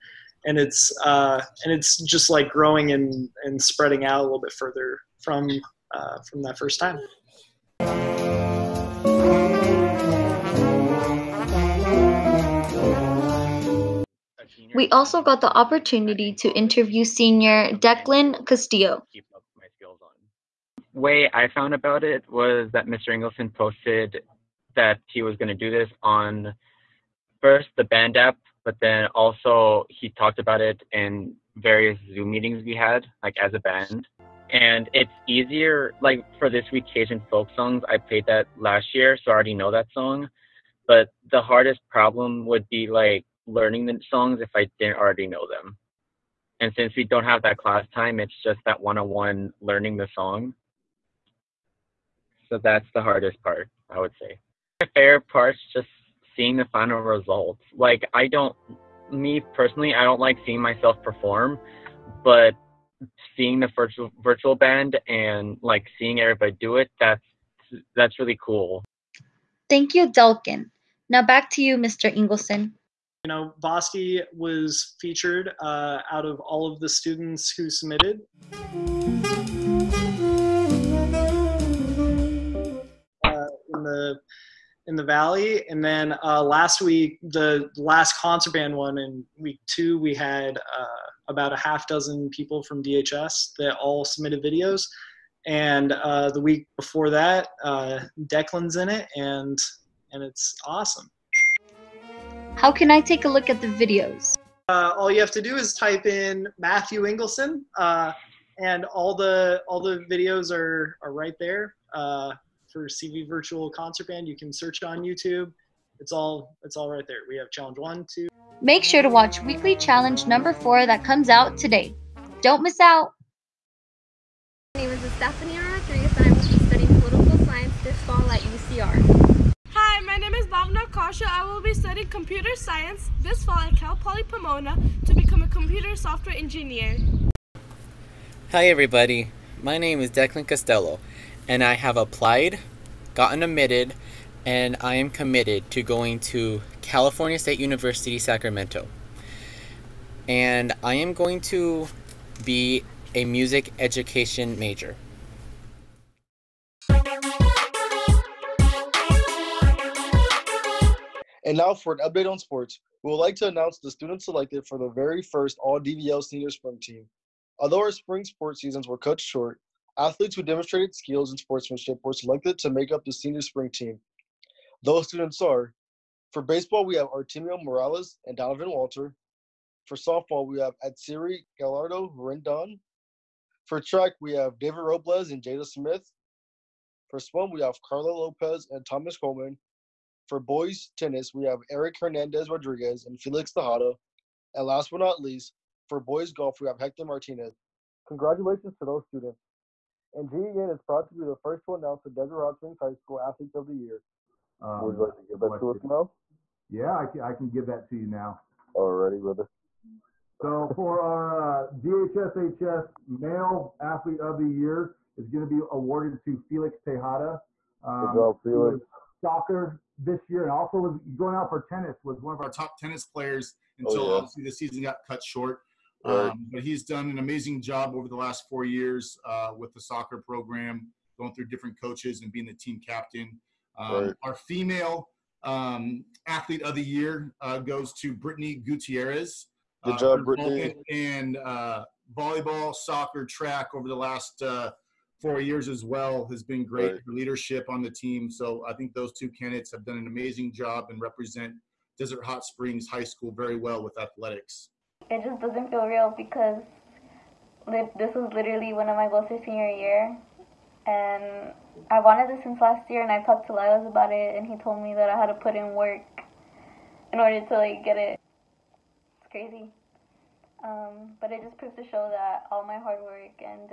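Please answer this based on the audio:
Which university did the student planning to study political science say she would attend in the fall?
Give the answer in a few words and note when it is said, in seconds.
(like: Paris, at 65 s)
UCR, at 128 s.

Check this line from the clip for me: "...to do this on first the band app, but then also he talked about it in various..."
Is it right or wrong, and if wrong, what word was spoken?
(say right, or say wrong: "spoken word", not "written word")
right.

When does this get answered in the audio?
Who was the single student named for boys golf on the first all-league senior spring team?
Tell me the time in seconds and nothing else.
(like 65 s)
196 s.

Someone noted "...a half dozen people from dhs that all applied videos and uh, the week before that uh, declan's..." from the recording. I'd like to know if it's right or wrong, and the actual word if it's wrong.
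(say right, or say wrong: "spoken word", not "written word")
wrong: "submitted", not "applied".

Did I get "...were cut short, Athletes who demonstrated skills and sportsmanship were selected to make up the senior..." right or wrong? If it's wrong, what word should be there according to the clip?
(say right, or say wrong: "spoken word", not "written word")
right.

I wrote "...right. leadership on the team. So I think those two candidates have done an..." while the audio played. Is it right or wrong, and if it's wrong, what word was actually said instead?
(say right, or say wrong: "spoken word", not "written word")
right.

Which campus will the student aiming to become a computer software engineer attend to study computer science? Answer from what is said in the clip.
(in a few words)
Cal Poly Pomona.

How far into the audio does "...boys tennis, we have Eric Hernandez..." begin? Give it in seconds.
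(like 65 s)
190 s.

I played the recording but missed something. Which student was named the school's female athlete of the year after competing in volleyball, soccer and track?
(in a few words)
Brittany Gutierrez.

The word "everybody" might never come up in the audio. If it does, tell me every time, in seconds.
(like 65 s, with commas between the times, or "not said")
66 s, 138 s.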